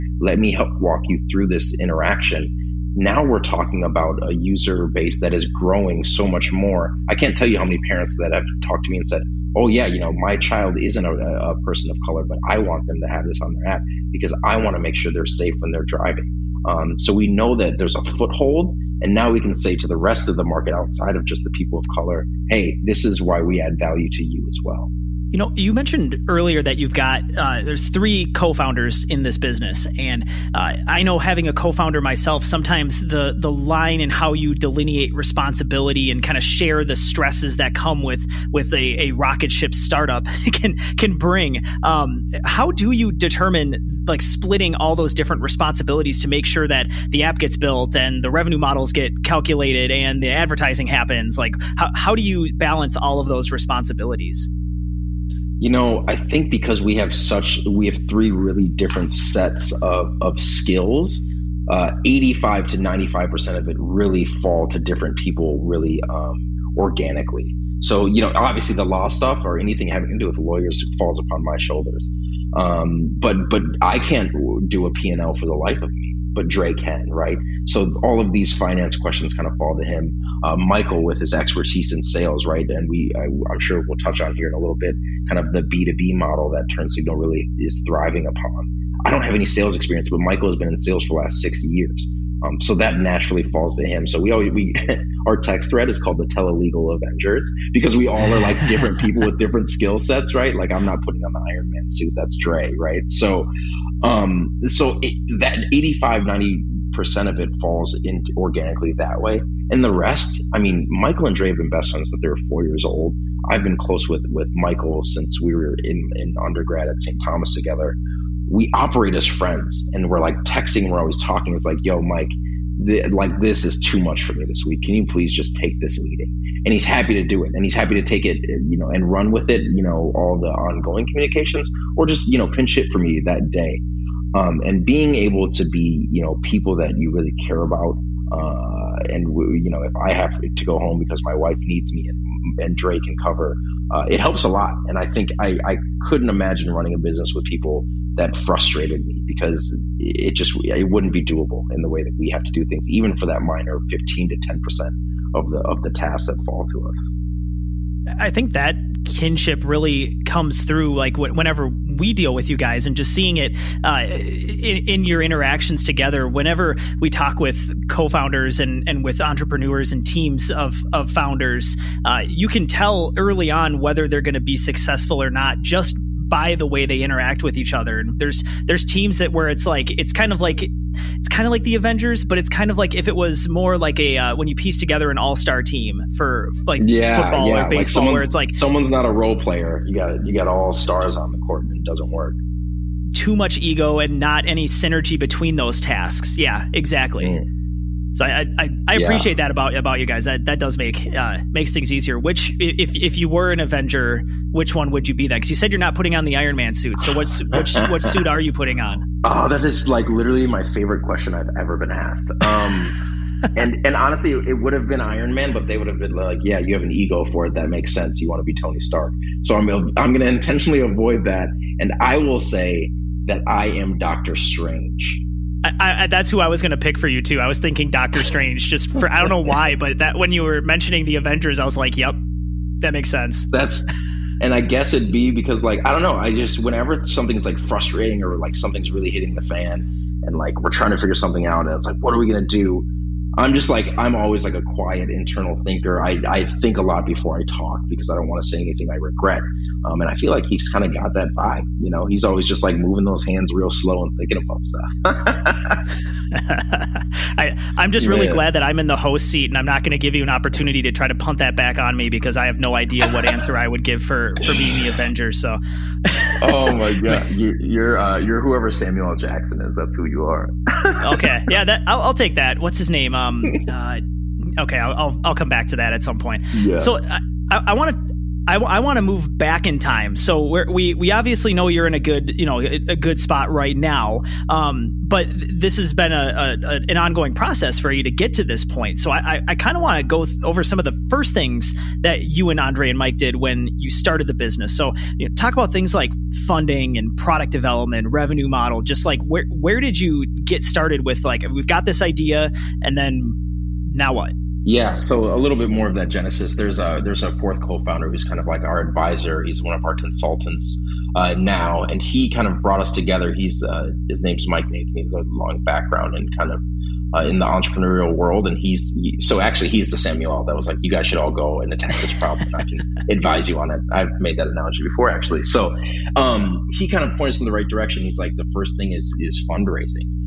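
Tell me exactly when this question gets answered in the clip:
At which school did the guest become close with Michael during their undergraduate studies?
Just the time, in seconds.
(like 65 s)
117 s.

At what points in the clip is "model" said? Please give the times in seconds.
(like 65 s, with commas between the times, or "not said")
48 s, 86 s, 298 s.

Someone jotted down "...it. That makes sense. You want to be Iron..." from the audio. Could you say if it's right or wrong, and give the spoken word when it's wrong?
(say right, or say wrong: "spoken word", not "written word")
wrong: "Tony", not "Iron".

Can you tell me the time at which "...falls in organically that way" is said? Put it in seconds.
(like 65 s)
107 s.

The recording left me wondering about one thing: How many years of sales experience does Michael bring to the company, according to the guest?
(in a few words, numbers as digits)
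6.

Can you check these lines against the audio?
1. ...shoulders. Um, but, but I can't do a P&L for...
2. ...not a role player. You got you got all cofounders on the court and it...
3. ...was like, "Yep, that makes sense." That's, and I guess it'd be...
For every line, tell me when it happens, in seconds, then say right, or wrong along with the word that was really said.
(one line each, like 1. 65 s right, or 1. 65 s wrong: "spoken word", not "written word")
1. 71 s right
2. 188 s wrong: "stars", not "cofounders"
3. 231 s right.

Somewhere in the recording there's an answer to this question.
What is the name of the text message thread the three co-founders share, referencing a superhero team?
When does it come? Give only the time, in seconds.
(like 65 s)
96 s.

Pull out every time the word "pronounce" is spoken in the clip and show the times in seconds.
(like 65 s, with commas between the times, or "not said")
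not said.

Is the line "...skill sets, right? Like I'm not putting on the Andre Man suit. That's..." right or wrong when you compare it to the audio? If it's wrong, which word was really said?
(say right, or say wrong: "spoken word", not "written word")
wrong: "Iron", not "Andre".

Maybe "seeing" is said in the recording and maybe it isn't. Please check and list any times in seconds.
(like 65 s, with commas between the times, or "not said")
163 s.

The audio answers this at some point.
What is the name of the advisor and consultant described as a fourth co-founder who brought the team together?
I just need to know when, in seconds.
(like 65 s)
314 s.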